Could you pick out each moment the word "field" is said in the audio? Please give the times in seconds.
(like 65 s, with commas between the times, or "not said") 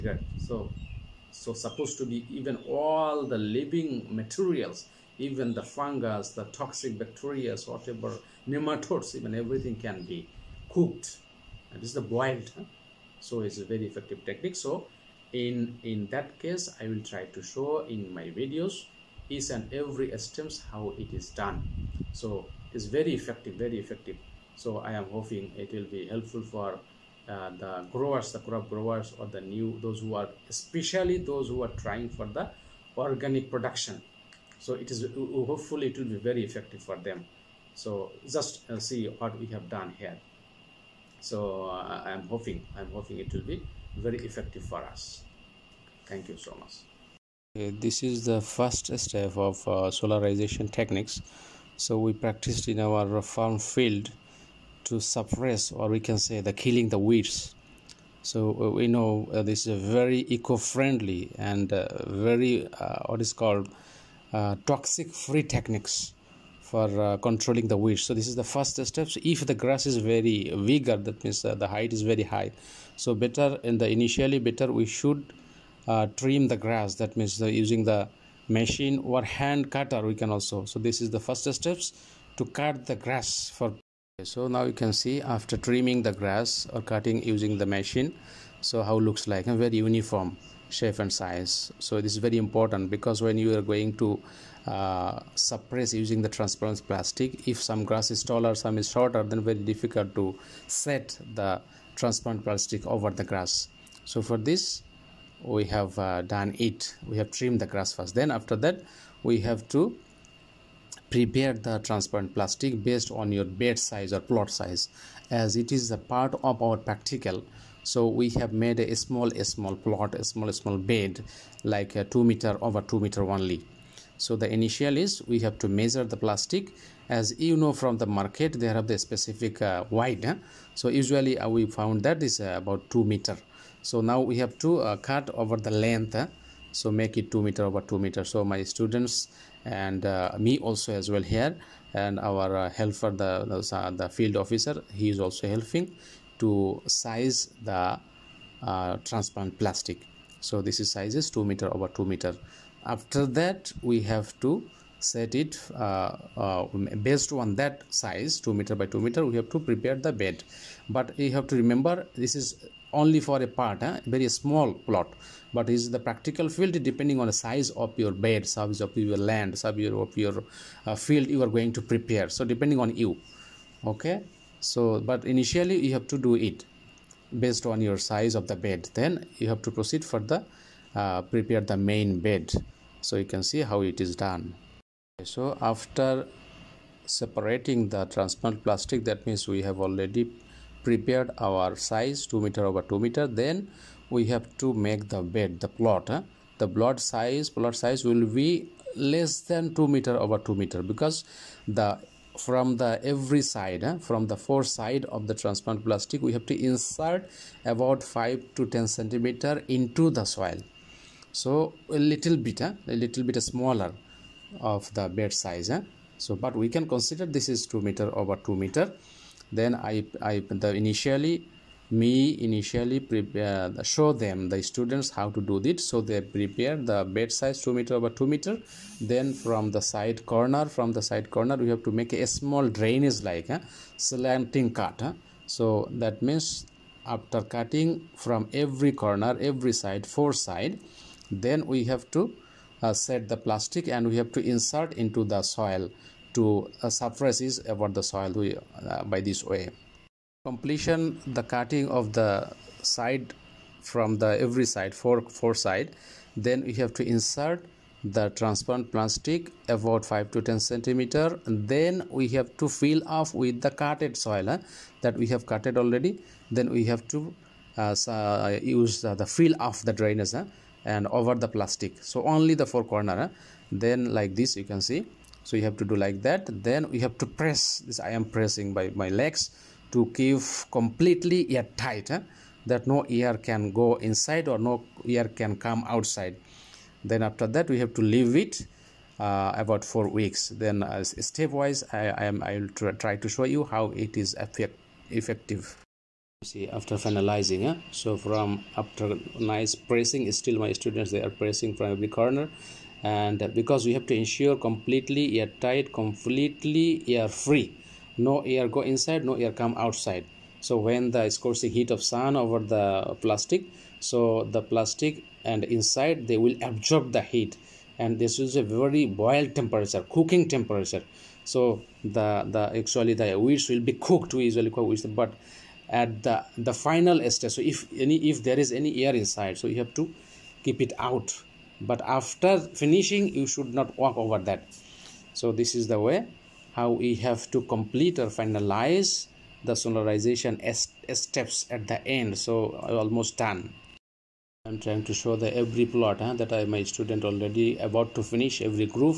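53 s, 144 s, 166 s, 170 s.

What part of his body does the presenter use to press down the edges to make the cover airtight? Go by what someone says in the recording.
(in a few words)
legs.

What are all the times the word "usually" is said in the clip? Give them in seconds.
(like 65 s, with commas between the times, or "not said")
130 s, 324 s.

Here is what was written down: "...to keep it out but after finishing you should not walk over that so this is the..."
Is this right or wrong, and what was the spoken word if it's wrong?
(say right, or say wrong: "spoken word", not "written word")
right.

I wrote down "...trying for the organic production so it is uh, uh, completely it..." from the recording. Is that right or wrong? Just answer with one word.
wrong.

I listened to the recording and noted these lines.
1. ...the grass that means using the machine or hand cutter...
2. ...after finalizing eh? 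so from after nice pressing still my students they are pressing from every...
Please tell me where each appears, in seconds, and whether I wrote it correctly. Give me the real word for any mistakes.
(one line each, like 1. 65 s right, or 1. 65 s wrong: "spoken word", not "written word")
1. 76 s right
2. 296 s right.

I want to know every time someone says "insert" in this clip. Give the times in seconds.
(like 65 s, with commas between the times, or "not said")
206 s, 244 s, 257 s.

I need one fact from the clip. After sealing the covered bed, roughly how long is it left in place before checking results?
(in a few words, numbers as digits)
about four weeks.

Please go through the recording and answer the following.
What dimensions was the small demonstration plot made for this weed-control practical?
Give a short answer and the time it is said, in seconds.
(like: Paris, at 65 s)
2 meters by 2 meters, at 122 s.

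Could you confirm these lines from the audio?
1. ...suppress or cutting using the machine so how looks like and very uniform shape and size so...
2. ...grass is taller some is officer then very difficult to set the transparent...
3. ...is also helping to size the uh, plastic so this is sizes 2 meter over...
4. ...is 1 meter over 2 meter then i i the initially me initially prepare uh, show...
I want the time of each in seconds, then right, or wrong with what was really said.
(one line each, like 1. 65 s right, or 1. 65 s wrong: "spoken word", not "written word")
1. 86 s wrong: "grass", not "suppress"
2. 97 s wrong: "shorter", not "officer"
3. 145 s right
4. 217 s wrong: "2", not "1".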